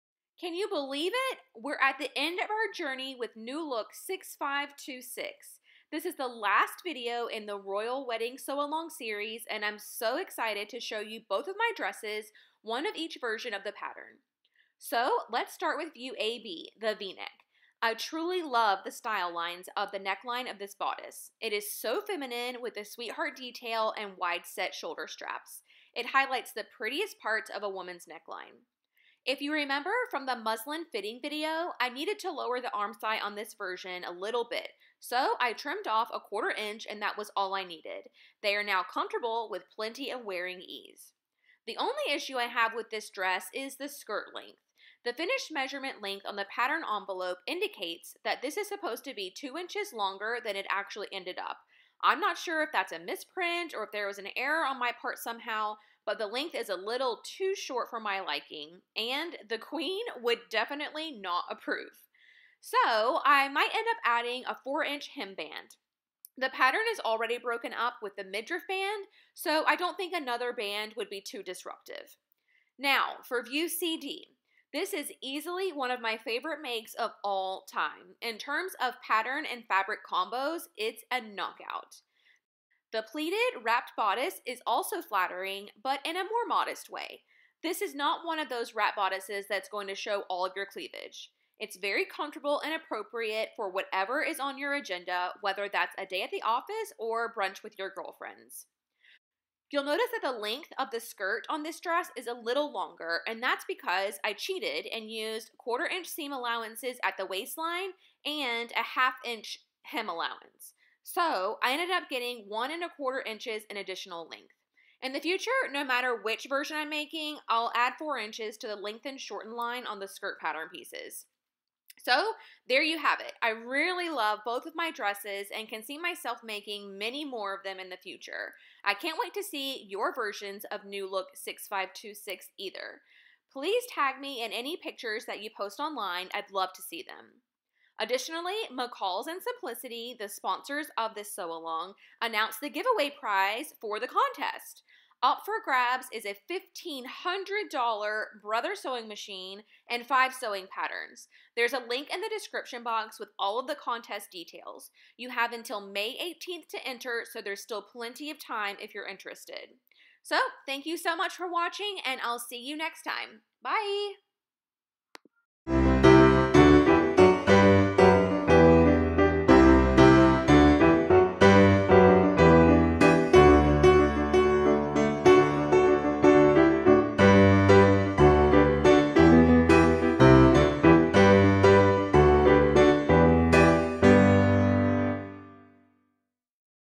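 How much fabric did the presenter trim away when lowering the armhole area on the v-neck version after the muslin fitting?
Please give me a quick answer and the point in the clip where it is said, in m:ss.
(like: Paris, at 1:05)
1/4 inch, at 0:36.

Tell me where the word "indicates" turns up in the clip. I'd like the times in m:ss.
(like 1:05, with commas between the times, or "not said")
0:47.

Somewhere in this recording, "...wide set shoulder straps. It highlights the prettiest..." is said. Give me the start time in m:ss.
0:24.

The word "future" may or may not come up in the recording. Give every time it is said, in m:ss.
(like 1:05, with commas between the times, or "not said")
1:55, 2:07.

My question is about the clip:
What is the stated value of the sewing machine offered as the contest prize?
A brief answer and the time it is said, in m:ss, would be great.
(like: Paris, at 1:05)
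$1,500, at 2:26.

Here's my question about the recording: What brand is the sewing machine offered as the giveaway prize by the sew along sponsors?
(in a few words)
Brother.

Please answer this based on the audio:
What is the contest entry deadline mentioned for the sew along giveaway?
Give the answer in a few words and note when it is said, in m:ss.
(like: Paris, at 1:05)
May 18th, at 2:35.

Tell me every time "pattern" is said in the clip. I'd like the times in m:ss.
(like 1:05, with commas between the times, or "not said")
0:13, 0:46, 1:06, 1:19, 2:00, 2:30.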